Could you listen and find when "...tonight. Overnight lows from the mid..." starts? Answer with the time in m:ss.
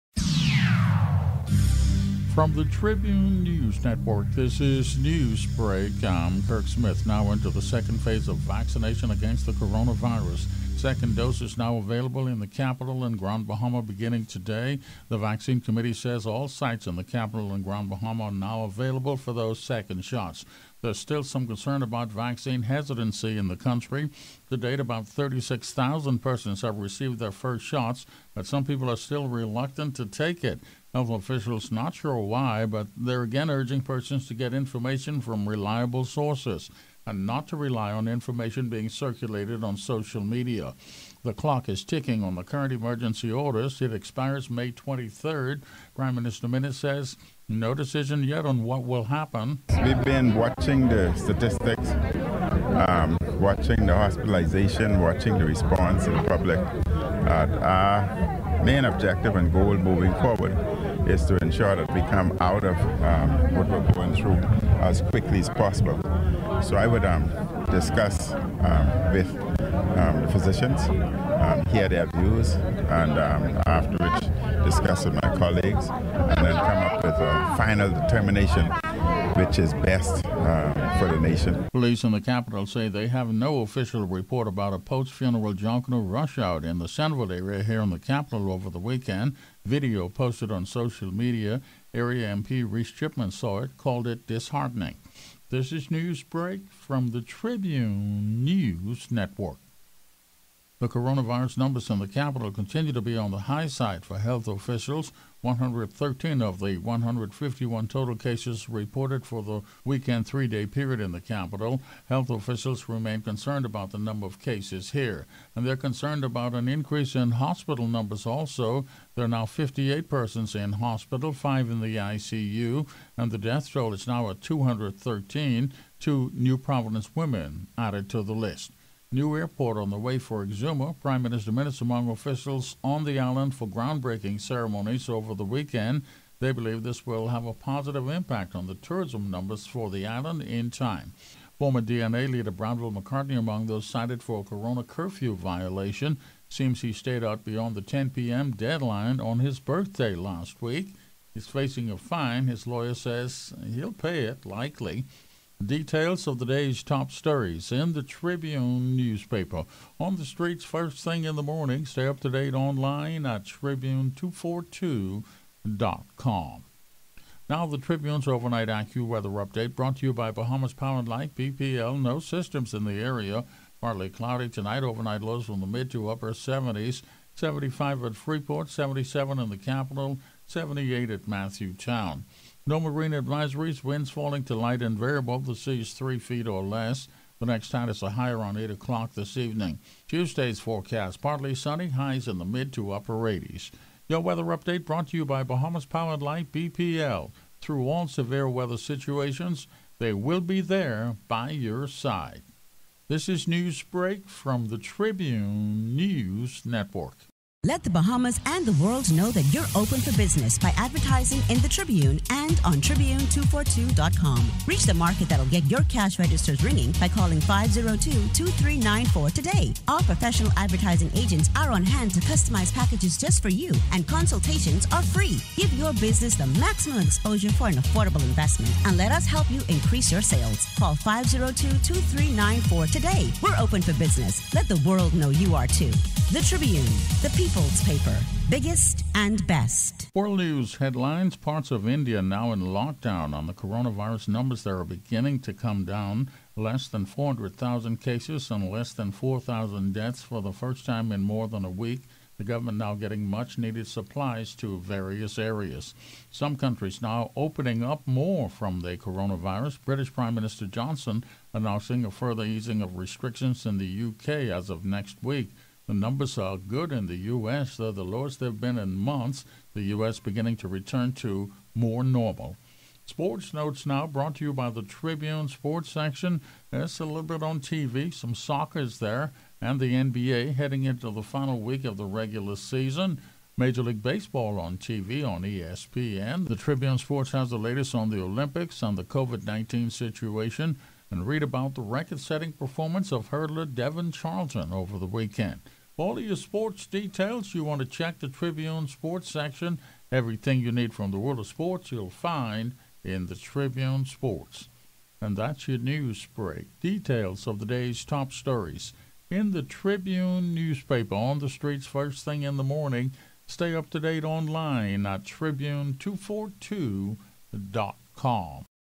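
2:54.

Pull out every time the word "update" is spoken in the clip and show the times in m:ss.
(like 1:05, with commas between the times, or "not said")
2:49, 3:14.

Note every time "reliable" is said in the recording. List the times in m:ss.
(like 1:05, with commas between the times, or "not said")
0:35.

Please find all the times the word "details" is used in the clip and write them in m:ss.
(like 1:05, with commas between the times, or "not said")
2:35, 4:56, 5:06.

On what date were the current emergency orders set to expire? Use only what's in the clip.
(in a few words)
May 23rd.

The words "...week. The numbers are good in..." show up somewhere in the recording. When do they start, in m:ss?
4:25.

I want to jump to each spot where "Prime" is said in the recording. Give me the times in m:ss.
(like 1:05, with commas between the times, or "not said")
0:45, 2:11, 4:20.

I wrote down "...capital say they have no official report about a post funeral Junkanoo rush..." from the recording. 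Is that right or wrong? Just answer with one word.
right.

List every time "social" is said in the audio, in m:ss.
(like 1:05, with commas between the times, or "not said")
0:39, 1:30.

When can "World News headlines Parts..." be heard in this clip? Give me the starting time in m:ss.
4:00.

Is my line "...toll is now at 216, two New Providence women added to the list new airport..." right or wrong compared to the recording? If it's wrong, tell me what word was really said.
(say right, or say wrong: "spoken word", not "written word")
wrong: "213", not "216".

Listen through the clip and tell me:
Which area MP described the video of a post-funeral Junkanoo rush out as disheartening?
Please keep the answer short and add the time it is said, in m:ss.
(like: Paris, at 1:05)
Reece Chipman, at 1:32.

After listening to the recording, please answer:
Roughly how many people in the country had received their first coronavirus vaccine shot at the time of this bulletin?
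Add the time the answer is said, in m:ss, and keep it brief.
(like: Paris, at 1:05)
36,000, at 0:25.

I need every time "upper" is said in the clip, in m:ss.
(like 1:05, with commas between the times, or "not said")
2:56, 3:12.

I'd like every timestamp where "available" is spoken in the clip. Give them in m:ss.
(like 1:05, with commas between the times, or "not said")
0:11, 0:18.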